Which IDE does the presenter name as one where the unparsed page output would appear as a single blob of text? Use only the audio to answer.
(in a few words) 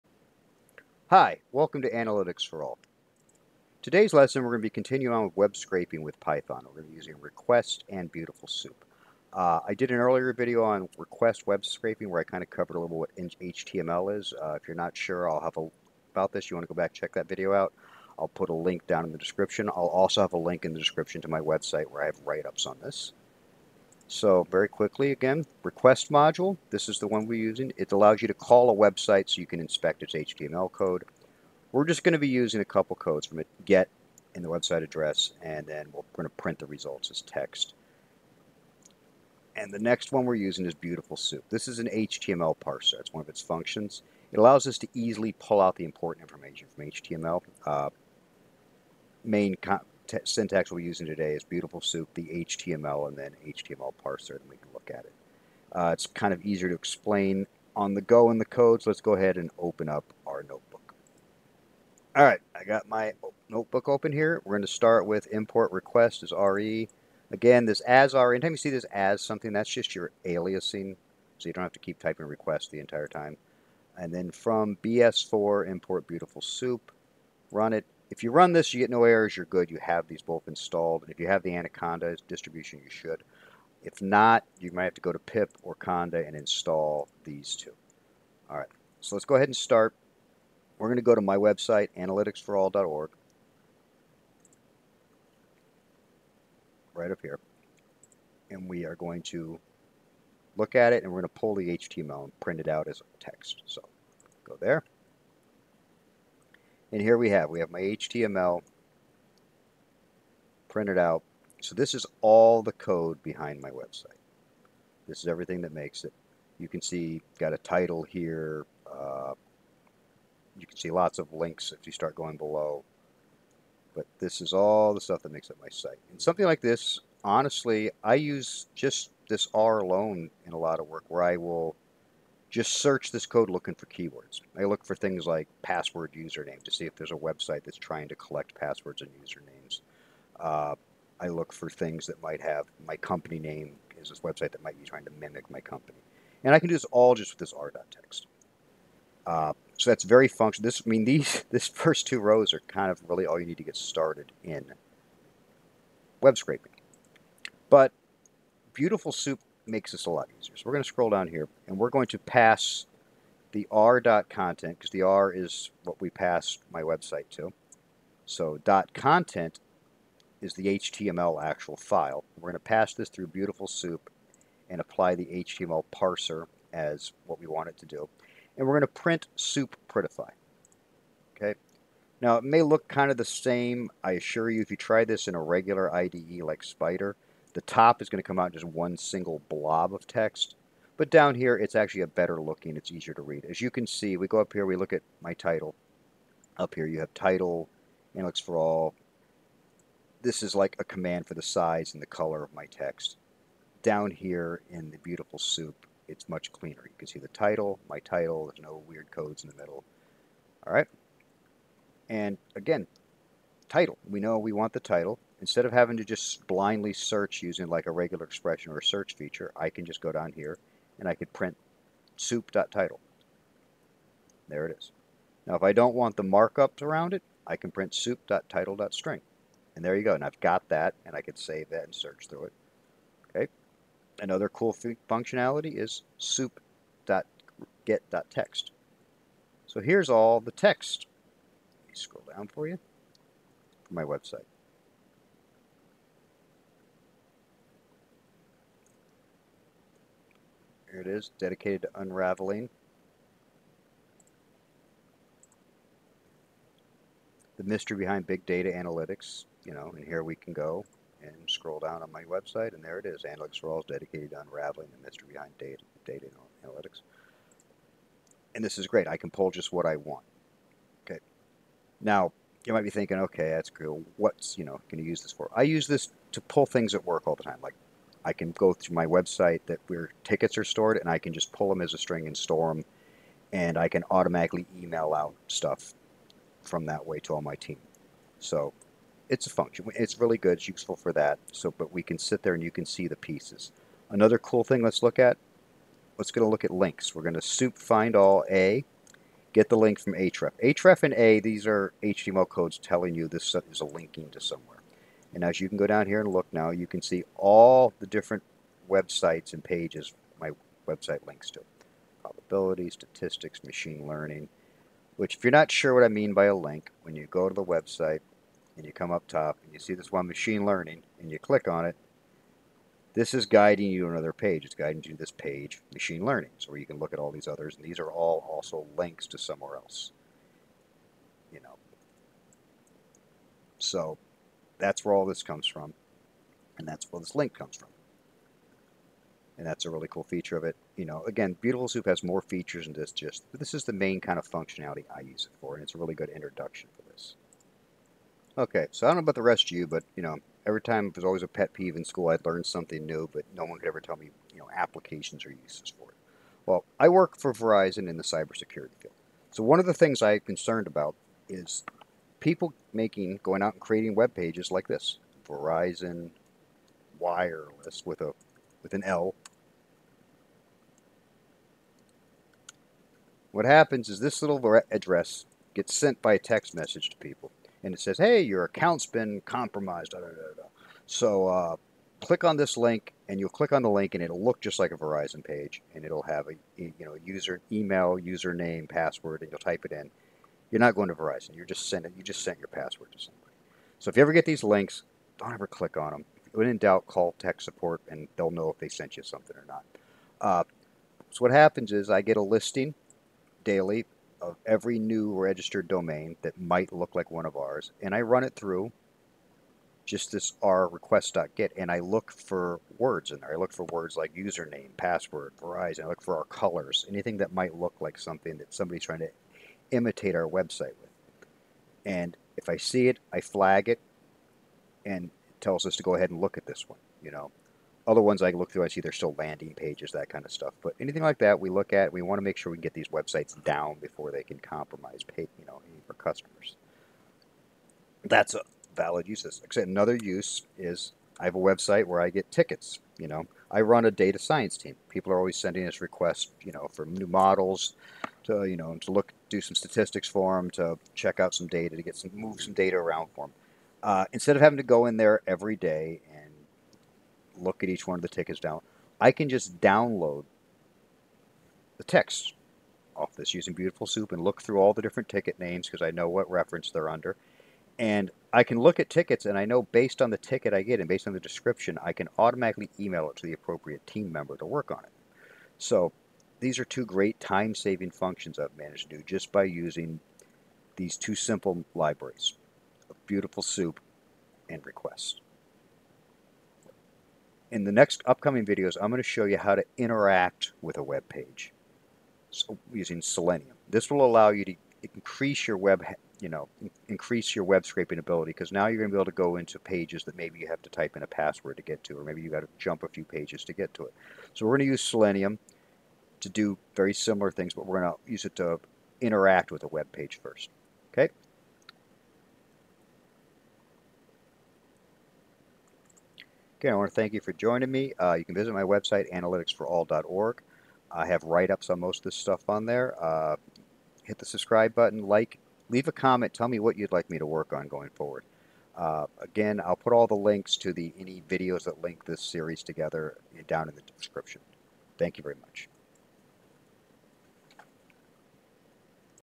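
Spyder.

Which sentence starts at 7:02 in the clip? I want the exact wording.
And if I see it, I flag it and it tells us to go ahead and look at this one, you know.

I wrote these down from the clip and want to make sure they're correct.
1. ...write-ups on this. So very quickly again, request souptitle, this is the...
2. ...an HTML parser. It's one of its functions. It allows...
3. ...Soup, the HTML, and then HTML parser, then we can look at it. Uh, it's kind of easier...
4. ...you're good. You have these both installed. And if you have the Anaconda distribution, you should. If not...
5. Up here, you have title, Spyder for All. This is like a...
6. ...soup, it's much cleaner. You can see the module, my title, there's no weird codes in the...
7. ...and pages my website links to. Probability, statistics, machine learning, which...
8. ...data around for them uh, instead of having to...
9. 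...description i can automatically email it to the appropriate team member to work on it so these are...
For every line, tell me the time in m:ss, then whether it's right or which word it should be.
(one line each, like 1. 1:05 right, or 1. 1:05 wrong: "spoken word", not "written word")
1. 0:22 wrong: "module", not "souptitle"
2. 0:41 right
3. 0:51 right
4. 1:19 right
5. 3:16 wrong: "Analytics", not "Spyder"
6. 3:25 wrong: "title", not "module"
7. 5:09 right
8. 7:32 right
9. 7:51 right.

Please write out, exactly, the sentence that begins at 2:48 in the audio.
So dot content is the HTML actual file.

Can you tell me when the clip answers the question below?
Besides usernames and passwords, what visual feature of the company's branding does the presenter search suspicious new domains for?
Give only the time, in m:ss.
6:56.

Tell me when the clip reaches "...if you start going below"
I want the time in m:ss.
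2:01.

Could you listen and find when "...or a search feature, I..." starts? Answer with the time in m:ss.
3:38.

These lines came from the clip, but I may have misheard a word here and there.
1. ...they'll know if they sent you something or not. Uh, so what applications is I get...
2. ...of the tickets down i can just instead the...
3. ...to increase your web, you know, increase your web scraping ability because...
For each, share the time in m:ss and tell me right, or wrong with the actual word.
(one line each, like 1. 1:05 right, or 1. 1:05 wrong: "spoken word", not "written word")
1. 6:38 wrong: "happens", not "applications"
2. 7:38 wrong: "download", not "instead"
3. 8:14 right.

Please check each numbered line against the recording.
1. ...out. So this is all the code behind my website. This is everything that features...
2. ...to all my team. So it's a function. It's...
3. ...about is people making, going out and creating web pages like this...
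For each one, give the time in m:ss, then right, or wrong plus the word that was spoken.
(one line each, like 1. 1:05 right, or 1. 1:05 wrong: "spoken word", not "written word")
1. 1:50 wrong: "makes", not "features"
2. 4:47 right
3. 6:00 right.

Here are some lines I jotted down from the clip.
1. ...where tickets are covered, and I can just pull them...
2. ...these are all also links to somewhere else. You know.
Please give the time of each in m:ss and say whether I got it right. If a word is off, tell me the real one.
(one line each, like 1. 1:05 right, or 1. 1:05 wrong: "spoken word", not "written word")
1. 4:39 wrong: "stored", not "covered"
2. 5:27 right.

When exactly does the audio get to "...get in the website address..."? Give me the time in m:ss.
0:33.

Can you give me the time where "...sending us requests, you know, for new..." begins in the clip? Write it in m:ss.
7:25.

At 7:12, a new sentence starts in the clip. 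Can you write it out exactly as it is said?
We want to make sure we get these websites down before they can compromise, pay, you know, for customers.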